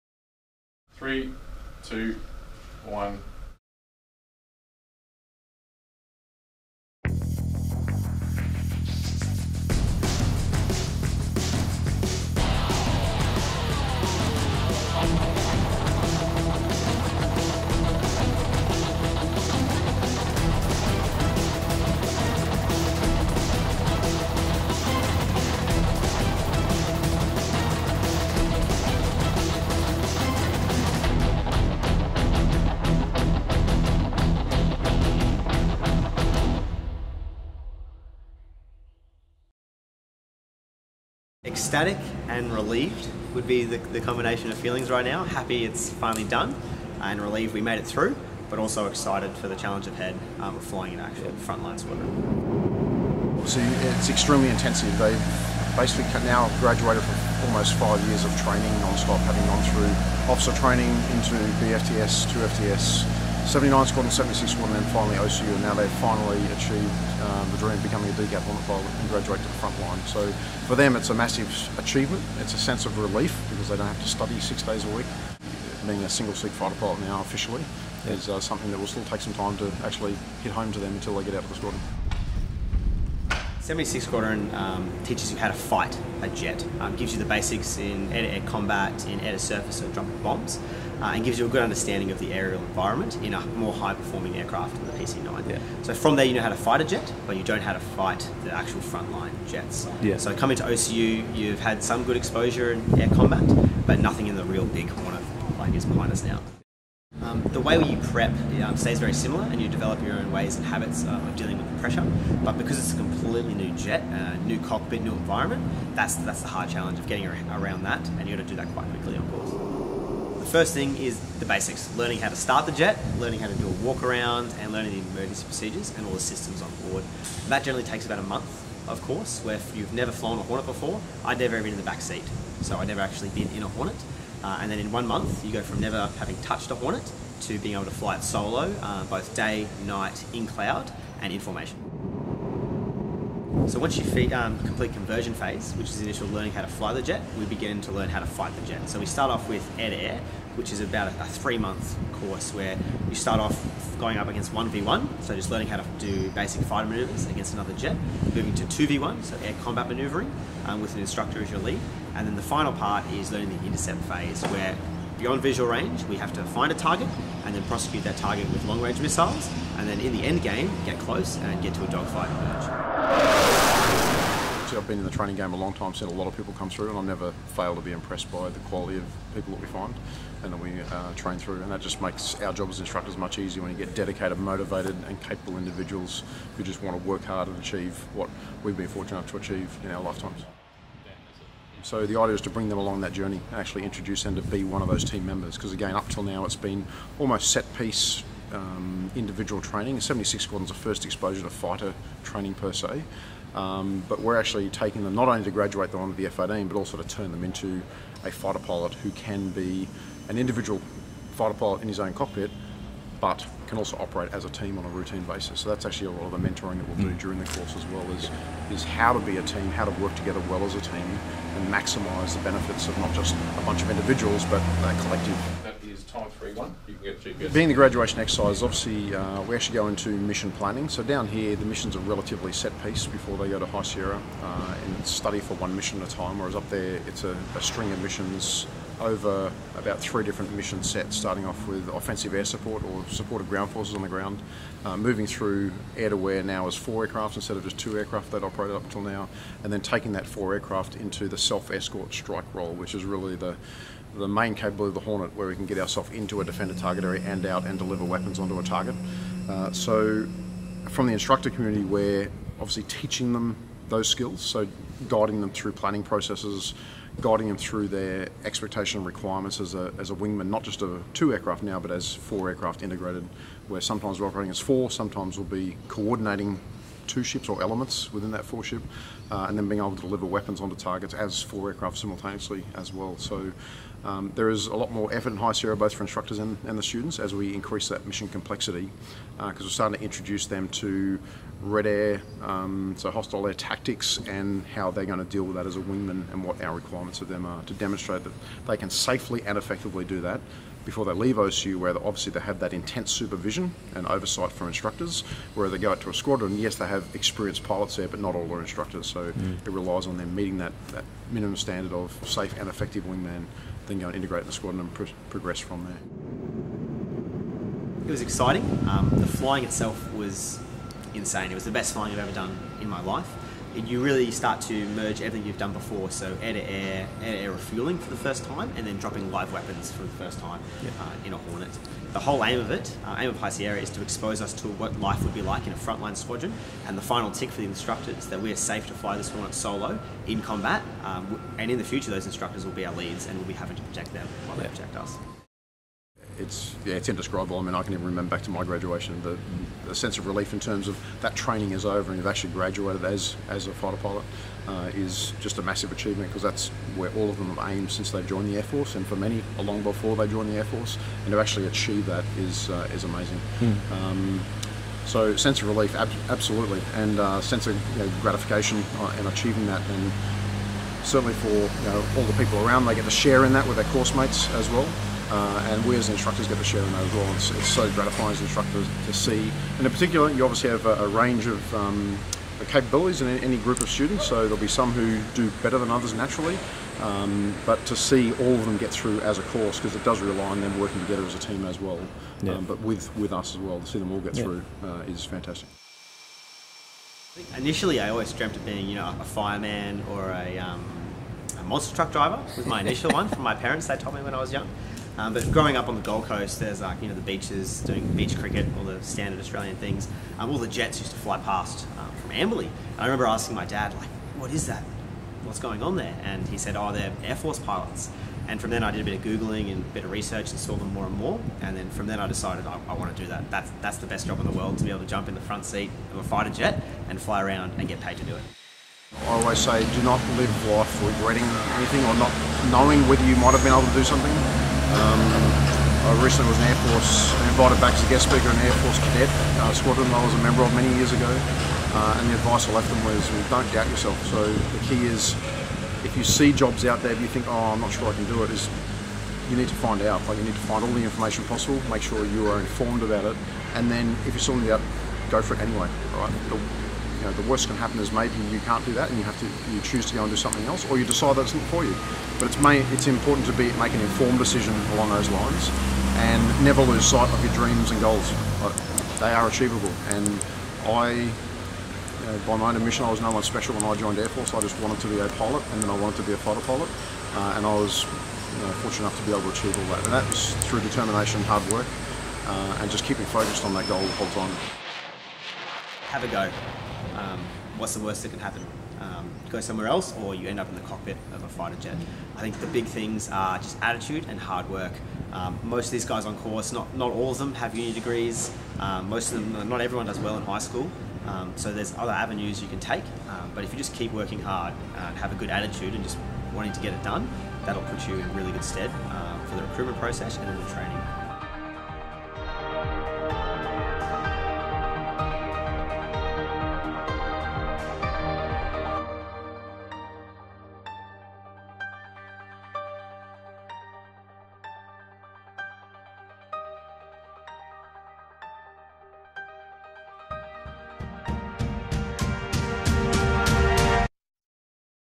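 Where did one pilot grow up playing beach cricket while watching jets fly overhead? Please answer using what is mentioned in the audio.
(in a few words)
Gold Coast.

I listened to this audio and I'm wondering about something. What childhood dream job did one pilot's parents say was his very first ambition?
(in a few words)
Monster truck driver.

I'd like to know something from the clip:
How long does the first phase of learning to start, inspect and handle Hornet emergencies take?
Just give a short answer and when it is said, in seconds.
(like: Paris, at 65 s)
About a month, at 128 s.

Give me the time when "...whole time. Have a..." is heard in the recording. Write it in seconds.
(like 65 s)
484 s.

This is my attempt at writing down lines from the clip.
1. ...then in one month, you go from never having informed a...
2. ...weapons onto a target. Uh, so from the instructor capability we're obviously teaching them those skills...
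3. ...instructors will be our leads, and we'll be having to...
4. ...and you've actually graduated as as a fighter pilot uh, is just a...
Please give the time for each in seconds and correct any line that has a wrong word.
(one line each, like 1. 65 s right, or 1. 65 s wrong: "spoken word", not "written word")
1. 134 s wrong: "touched", not "informed"
2. 258 s wrong: "community", not "capability"
3. 342 s right
4. 352 s right.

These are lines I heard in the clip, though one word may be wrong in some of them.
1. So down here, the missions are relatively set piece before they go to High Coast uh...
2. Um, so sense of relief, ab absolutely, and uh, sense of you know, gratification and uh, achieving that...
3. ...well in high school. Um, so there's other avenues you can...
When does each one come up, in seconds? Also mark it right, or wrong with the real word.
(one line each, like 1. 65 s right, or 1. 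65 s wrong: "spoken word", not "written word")
1. 230 s wrong: "Sierra", not "Coast"
2. 363 s right
3. 500 s right.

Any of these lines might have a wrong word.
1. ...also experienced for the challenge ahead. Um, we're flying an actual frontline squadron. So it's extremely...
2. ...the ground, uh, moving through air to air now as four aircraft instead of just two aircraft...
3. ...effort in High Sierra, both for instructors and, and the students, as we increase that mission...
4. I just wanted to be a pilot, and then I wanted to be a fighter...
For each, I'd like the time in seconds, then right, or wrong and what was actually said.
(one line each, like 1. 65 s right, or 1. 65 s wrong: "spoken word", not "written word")
1. 48 s wrong: "excited", not "experienced"
2. 244 s right
3. 285 s right
4. 474 s right.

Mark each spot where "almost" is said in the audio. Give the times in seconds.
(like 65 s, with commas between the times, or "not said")
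57 s, 197 s.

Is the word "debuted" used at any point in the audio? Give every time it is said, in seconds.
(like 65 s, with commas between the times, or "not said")
not said.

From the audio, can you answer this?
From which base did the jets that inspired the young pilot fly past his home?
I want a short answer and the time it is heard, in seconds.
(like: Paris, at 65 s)
Amberley, at 412 s.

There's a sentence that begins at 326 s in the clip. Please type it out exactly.
So air-to-air, air-to-air refueling for the first time, and then dropping live weapons for the first time uh, in a Hornet.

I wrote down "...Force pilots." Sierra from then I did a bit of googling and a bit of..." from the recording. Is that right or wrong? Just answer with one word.
wrong.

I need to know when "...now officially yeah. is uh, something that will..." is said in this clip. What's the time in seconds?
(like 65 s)
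77 s.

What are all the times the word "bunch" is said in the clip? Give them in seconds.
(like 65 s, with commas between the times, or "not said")
223 s.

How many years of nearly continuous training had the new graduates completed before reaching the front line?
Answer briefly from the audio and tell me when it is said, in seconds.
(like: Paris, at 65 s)
5, at 57 s.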